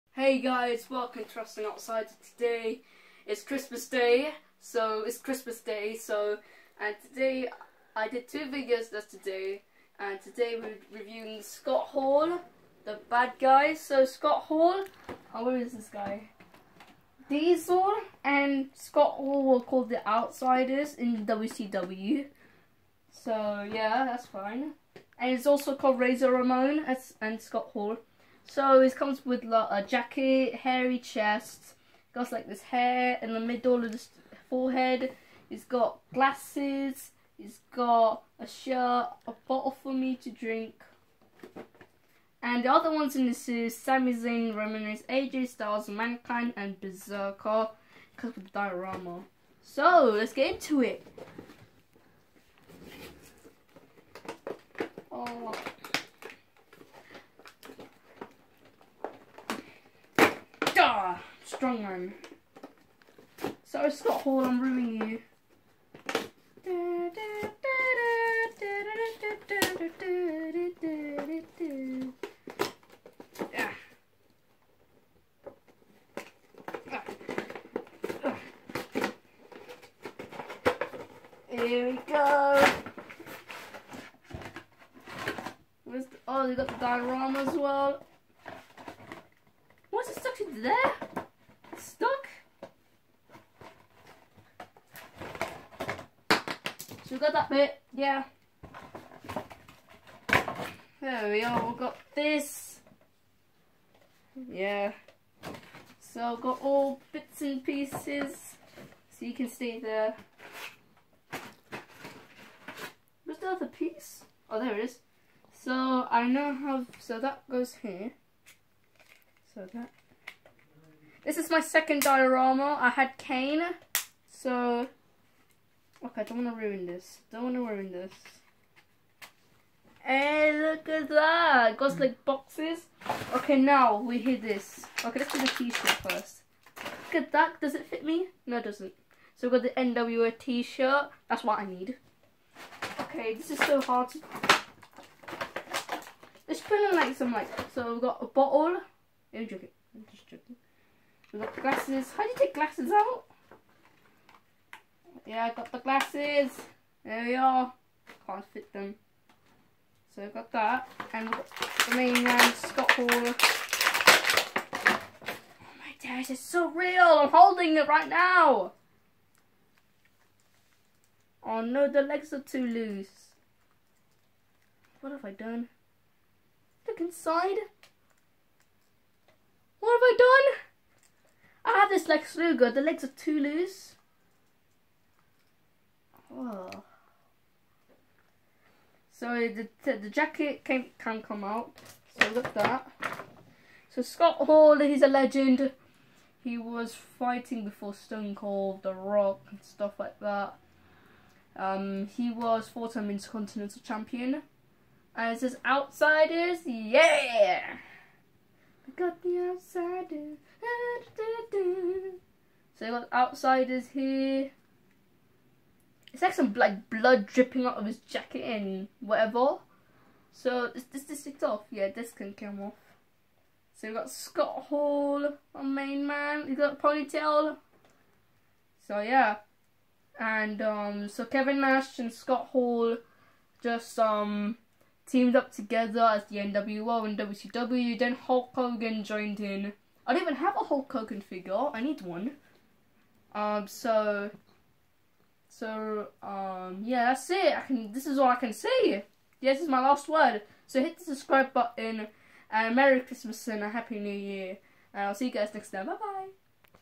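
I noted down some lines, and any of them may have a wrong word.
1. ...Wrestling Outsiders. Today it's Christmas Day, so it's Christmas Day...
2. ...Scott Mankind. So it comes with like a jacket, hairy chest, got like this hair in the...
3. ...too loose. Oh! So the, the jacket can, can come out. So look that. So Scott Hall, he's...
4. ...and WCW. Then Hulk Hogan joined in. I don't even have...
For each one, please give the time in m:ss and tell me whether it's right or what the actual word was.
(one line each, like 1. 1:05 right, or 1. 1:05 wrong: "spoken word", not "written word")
1. 0:01 right
2. 0:27 wrong: "Hall", not "Mankind"
3. 3:03 right
4. 3:57 right.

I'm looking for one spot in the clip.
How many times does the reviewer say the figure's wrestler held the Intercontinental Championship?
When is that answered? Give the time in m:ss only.
3:22.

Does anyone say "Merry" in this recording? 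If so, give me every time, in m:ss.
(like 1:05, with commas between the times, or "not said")
4:12.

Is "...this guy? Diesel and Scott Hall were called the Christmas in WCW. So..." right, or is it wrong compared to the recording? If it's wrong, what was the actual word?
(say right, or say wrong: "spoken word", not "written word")
wrong: "Outsiders", not "Christmas".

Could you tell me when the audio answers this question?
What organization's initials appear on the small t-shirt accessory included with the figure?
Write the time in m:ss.
2:19.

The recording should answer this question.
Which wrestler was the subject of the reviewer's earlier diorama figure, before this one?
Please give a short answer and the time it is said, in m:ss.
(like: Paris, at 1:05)
Kane, at 2:03.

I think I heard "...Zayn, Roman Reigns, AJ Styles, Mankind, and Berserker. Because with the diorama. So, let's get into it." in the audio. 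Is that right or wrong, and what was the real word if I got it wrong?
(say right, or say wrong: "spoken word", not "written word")
right.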